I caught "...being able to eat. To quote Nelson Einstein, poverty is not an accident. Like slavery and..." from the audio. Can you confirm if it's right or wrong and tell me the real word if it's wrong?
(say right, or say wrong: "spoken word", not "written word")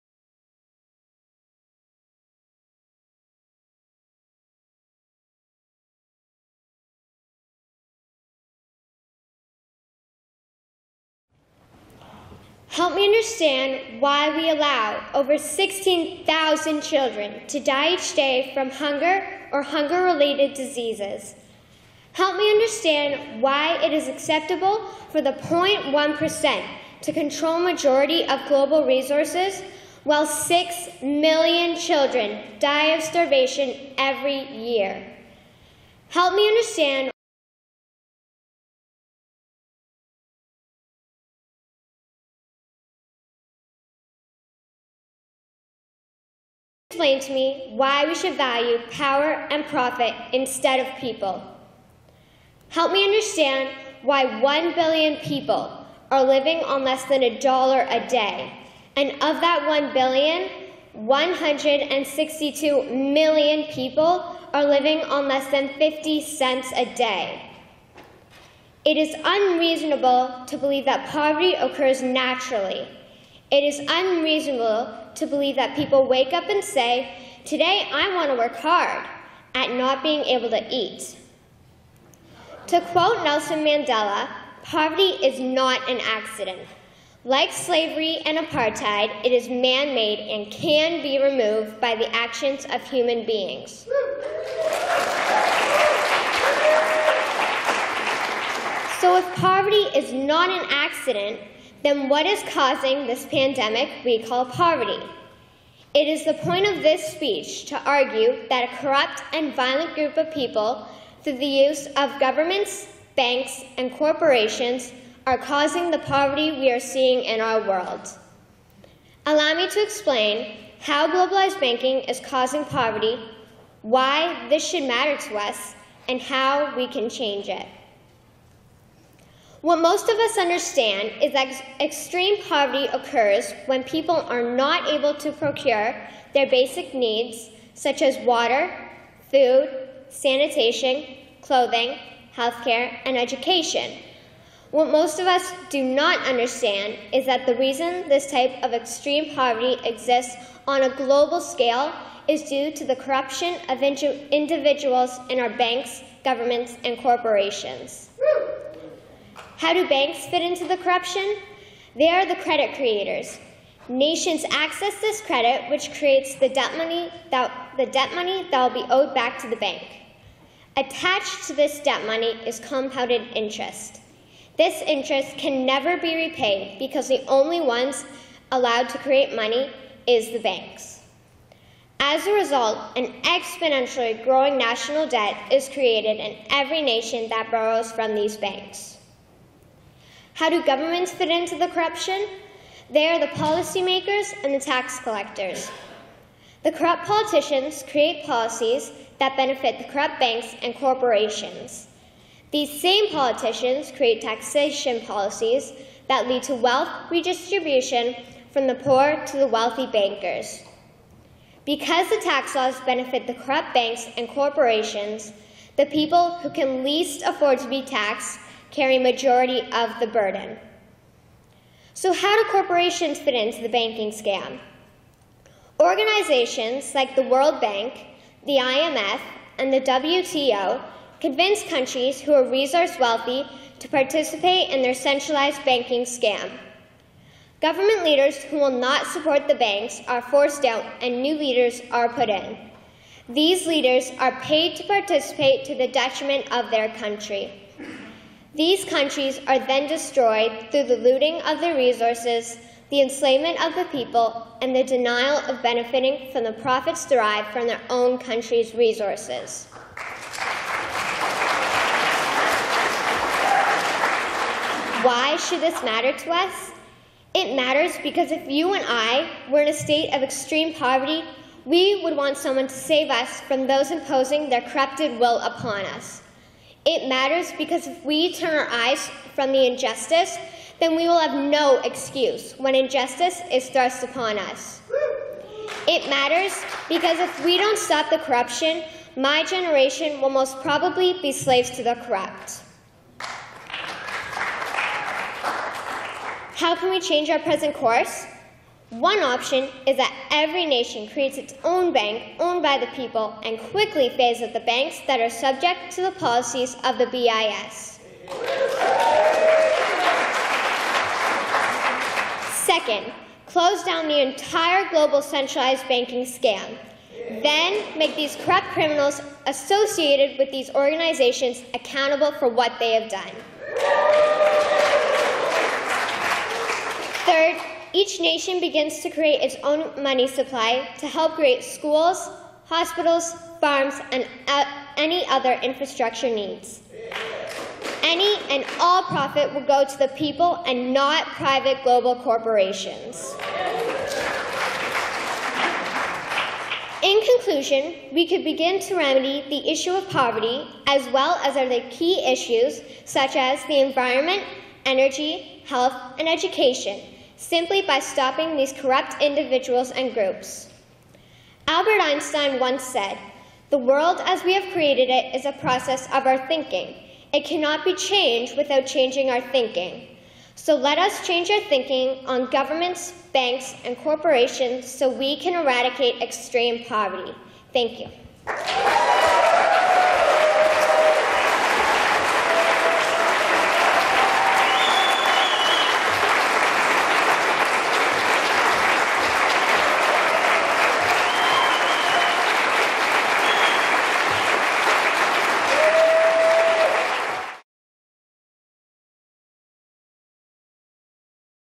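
wrong: "Mandela", not "Einstein".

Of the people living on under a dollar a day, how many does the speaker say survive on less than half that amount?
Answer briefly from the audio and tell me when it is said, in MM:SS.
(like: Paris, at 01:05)
162 million, at 01:00.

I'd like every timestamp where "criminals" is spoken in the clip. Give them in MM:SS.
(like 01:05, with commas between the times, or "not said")
05:18.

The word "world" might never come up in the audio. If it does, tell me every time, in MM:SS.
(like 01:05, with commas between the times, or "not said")
01:57, 03:47, 06:03.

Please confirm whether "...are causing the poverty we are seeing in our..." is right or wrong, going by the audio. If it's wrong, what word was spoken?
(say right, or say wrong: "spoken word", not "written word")
right.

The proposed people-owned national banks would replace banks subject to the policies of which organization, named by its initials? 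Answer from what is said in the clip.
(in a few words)
BIS.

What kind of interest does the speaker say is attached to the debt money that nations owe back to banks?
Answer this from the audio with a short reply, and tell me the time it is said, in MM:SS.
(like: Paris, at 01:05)
Compounded interest, at 02:52.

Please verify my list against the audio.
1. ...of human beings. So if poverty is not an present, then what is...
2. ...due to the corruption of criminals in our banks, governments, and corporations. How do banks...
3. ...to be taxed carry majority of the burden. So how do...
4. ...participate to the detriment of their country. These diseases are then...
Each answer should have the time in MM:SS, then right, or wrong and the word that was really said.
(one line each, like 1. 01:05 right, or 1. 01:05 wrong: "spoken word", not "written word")
1. 01:32 wrong: "accident", not "present"
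2. 02:32 wrong: "individuals", not "criminals"
3. 03:37 right
4. 04:04 wrong: "countries", not "diseases".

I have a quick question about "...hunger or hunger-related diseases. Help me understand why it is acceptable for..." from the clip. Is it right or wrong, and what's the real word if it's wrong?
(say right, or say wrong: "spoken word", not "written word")
right.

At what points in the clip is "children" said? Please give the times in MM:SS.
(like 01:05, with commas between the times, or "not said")
00:16, 00:31.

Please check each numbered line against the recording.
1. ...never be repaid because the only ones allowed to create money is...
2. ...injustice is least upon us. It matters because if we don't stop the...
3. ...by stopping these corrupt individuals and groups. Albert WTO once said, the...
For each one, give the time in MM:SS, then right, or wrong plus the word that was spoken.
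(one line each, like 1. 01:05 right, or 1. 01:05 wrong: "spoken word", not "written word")
1. 02:55 right
2. 04:42 wrong: "thrust", not "least"
3. 05:57 wrong: "Einstein", not "WTO".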